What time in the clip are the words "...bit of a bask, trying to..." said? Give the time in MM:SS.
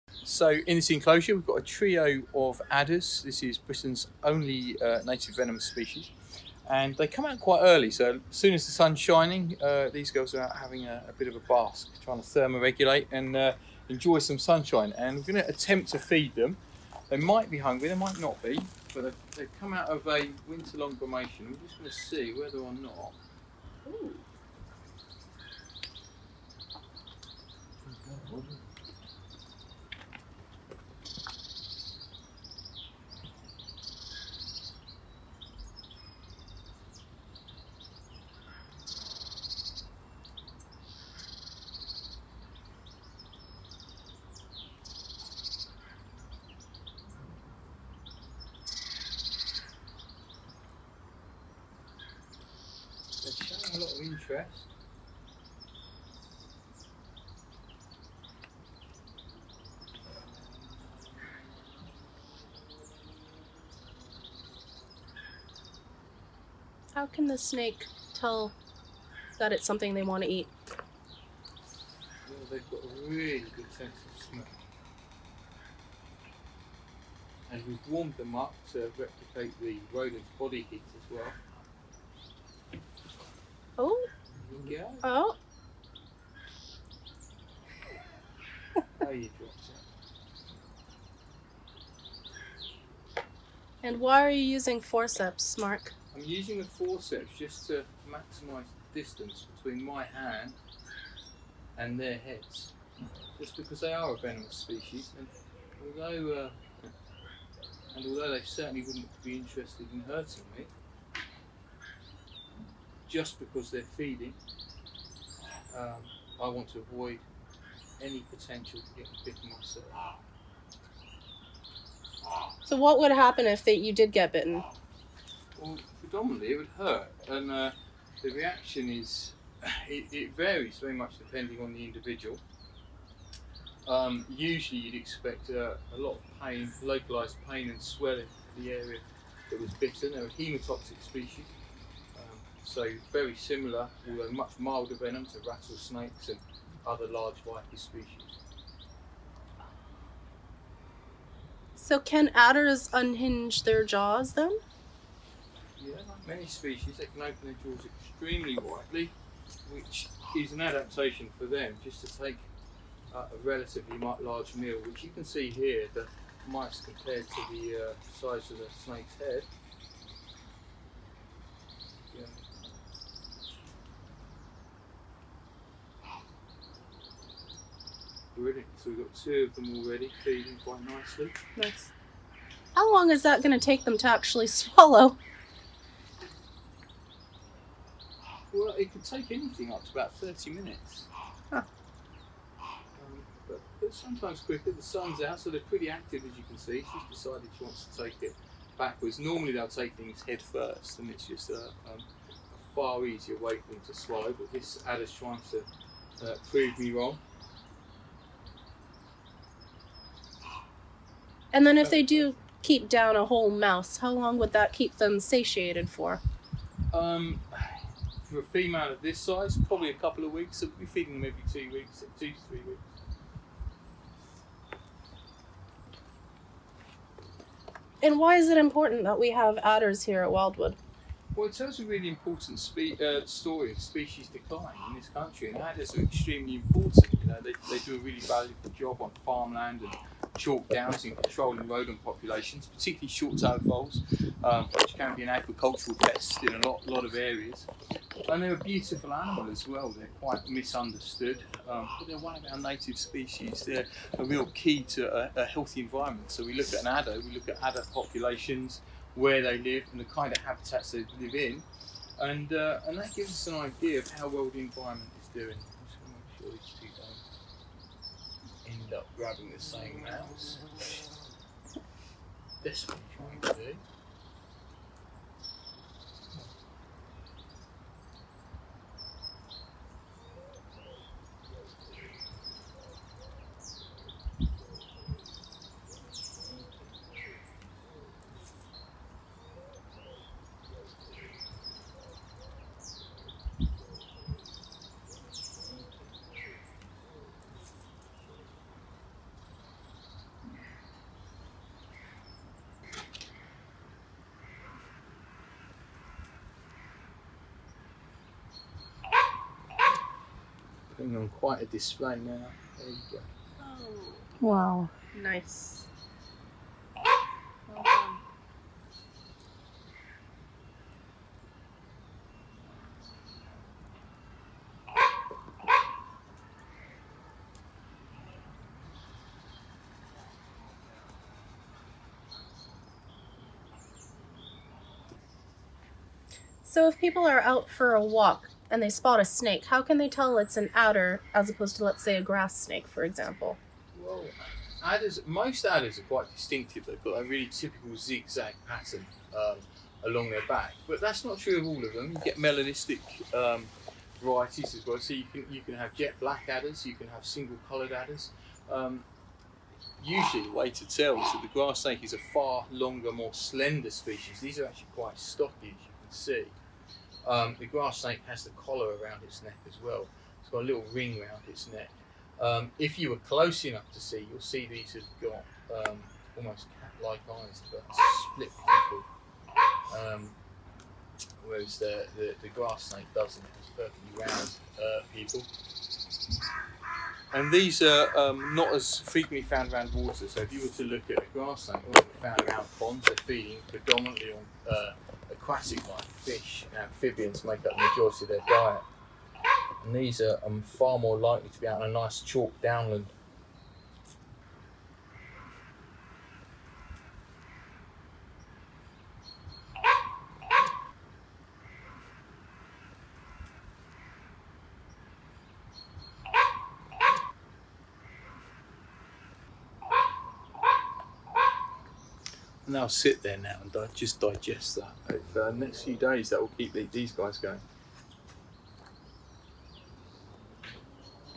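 00:11.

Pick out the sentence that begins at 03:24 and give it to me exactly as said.
But this adder's trying to uh, prove me wrong.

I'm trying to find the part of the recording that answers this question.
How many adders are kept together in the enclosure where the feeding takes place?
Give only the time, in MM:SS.
00:01.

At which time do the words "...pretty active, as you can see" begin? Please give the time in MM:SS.
03:15.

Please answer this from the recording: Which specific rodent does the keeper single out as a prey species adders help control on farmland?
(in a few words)
Short-tailed voles.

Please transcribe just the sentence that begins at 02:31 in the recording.
So can adders unhinge their jaws then?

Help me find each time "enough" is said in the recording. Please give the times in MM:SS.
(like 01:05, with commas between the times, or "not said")
06:13.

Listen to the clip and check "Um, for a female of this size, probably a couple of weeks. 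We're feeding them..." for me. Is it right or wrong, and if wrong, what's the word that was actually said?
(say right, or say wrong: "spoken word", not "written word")
right.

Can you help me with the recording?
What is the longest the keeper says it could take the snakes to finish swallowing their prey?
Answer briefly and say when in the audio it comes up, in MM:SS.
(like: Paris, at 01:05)
30 minutes, at 03:10.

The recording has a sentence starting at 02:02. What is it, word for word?
So what would happen if they, you did get bitten?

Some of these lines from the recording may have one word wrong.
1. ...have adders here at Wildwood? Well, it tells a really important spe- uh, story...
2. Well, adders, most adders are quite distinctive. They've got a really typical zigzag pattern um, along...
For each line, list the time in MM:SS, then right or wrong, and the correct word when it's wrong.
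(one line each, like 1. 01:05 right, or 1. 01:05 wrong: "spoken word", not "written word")
1. 03:49 right
2. 05:44 right.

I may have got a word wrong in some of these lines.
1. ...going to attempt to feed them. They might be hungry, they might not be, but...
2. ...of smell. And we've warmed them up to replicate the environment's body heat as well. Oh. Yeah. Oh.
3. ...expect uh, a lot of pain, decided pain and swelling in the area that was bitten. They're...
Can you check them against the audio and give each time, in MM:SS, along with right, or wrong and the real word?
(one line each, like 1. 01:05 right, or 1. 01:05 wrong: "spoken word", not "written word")
1. 00:15 right
2. 01:14 wrong: "rodent", not "environment"
3. 02:14 wrong: "localized", not "decided".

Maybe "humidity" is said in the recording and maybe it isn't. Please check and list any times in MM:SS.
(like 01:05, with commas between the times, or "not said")
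not said.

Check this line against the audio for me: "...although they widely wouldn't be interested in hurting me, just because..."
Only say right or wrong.
wrong.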